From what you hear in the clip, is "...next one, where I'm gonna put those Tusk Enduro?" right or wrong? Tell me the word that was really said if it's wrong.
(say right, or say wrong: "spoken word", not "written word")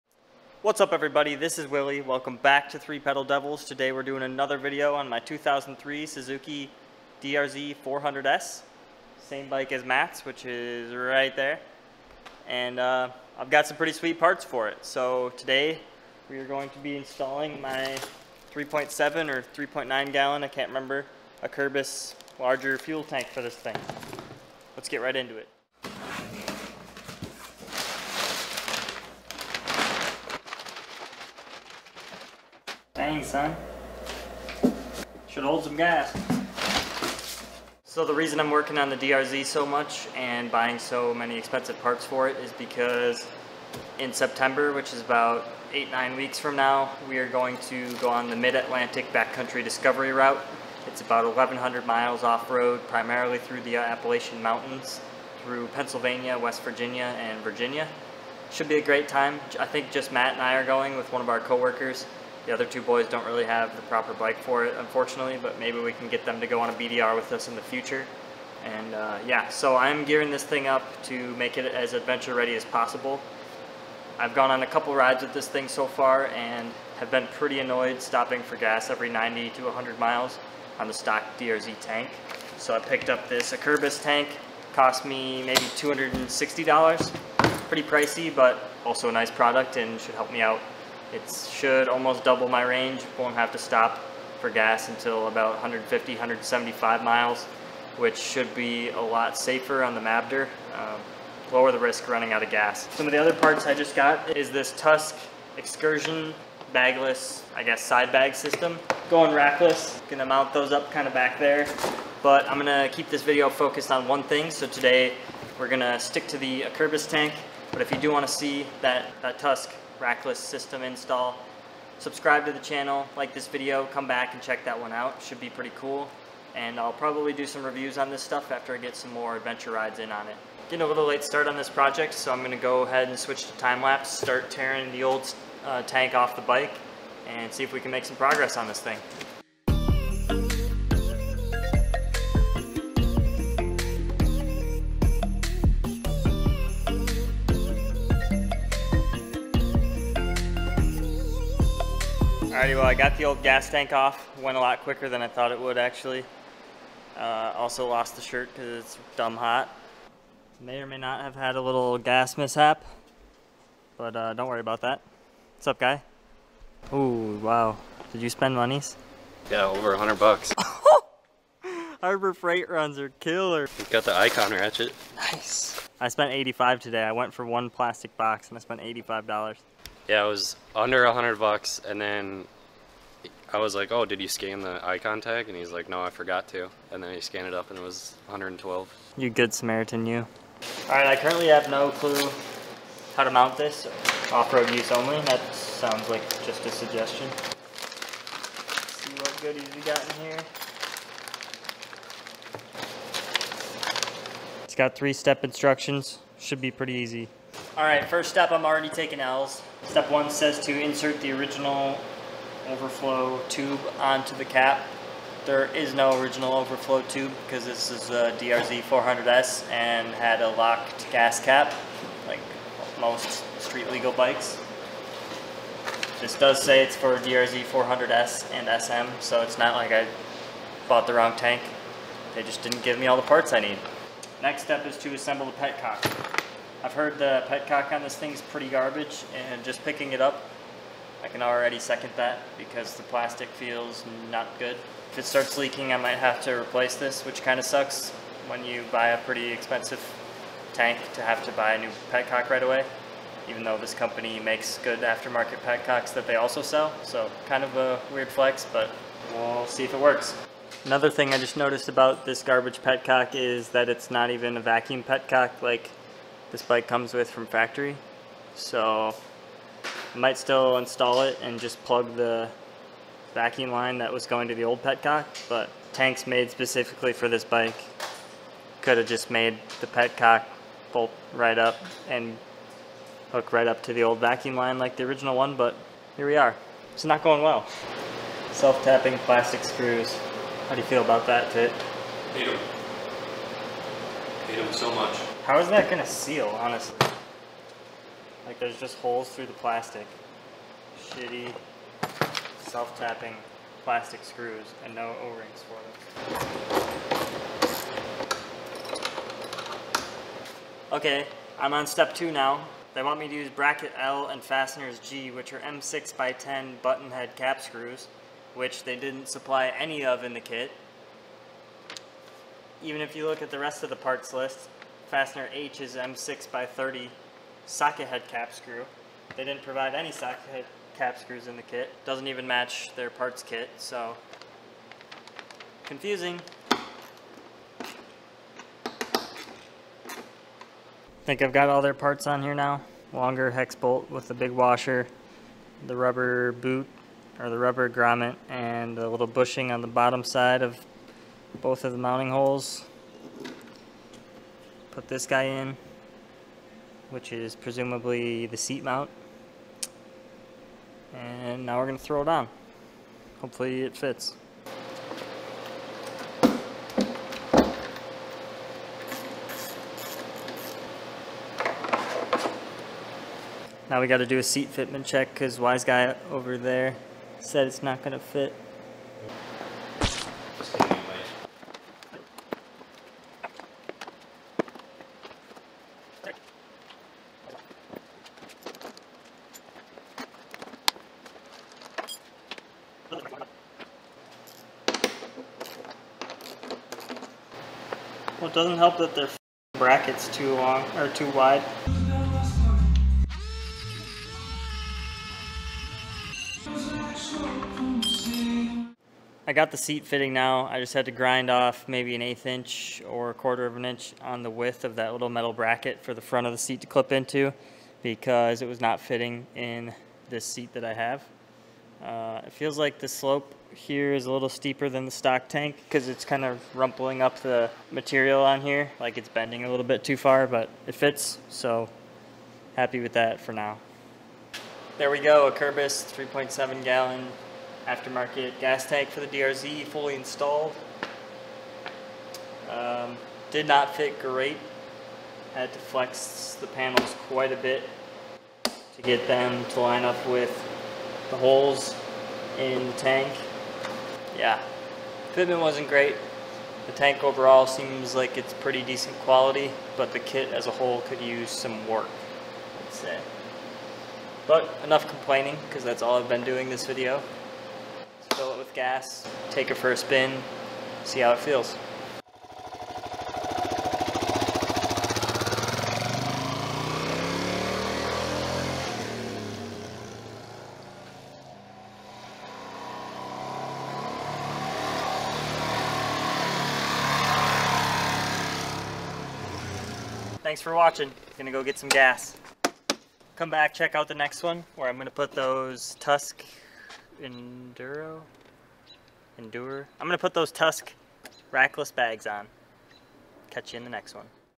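right.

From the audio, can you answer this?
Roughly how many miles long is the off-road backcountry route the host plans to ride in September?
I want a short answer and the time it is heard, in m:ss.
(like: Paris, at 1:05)
1,100 miles, at 0:51.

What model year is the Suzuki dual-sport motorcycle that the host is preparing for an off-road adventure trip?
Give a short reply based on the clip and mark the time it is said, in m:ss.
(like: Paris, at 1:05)
2003, at 0:05.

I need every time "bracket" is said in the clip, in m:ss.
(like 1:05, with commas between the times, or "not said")
5:13, 6:39, 6:55.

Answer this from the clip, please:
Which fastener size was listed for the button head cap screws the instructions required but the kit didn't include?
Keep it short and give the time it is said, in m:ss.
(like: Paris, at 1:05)
M6 by 10, at 5:15.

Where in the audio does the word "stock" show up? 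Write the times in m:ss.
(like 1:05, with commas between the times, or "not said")
1:20, 7:05.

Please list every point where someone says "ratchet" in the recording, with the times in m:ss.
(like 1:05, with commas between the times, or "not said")
2:54.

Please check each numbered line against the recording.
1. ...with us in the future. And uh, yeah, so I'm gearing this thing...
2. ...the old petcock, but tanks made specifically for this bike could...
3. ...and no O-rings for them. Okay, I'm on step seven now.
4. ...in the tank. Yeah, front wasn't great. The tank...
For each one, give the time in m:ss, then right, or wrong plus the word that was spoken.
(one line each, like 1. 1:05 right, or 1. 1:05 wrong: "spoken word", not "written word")
1. 1:07 right
2. 4:34 right
3. 5:04 wrong: "two", not "seven"
4. 7:32 wrong: "fitment", not "front".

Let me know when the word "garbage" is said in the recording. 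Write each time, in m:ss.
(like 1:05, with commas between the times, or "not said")
3:58, 4:22.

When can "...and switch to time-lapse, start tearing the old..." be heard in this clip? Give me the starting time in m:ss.
2:13.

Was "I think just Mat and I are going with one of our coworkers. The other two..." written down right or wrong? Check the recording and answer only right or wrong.
right.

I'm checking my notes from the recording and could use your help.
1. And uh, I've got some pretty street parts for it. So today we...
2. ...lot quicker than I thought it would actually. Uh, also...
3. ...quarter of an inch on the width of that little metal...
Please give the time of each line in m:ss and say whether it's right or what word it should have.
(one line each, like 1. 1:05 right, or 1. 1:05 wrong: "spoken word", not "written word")
1. 0:12 wrong: "sweet", not "street"
2. 2:34 right
3. 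6:53 right.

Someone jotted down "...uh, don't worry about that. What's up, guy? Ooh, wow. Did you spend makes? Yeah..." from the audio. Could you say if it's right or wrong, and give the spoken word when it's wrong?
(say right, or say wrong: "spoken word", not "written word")
wrong: "monies", not "makes".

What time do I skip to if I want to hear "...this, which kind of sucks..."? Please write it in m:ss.
4:06.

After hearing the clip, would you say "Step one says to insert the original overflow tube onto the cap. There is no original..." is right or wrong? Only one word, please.
right.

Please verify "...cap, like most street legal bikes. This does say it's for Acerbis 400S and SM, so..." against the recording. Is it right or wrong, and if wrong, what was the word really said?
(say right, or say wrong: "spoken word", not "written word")
wrong: "DRZ", not "Acerbis".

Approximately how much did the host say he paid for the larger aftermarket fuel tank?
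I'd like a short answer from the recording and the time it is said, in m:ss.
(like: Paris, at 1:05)
$260, at 1:25.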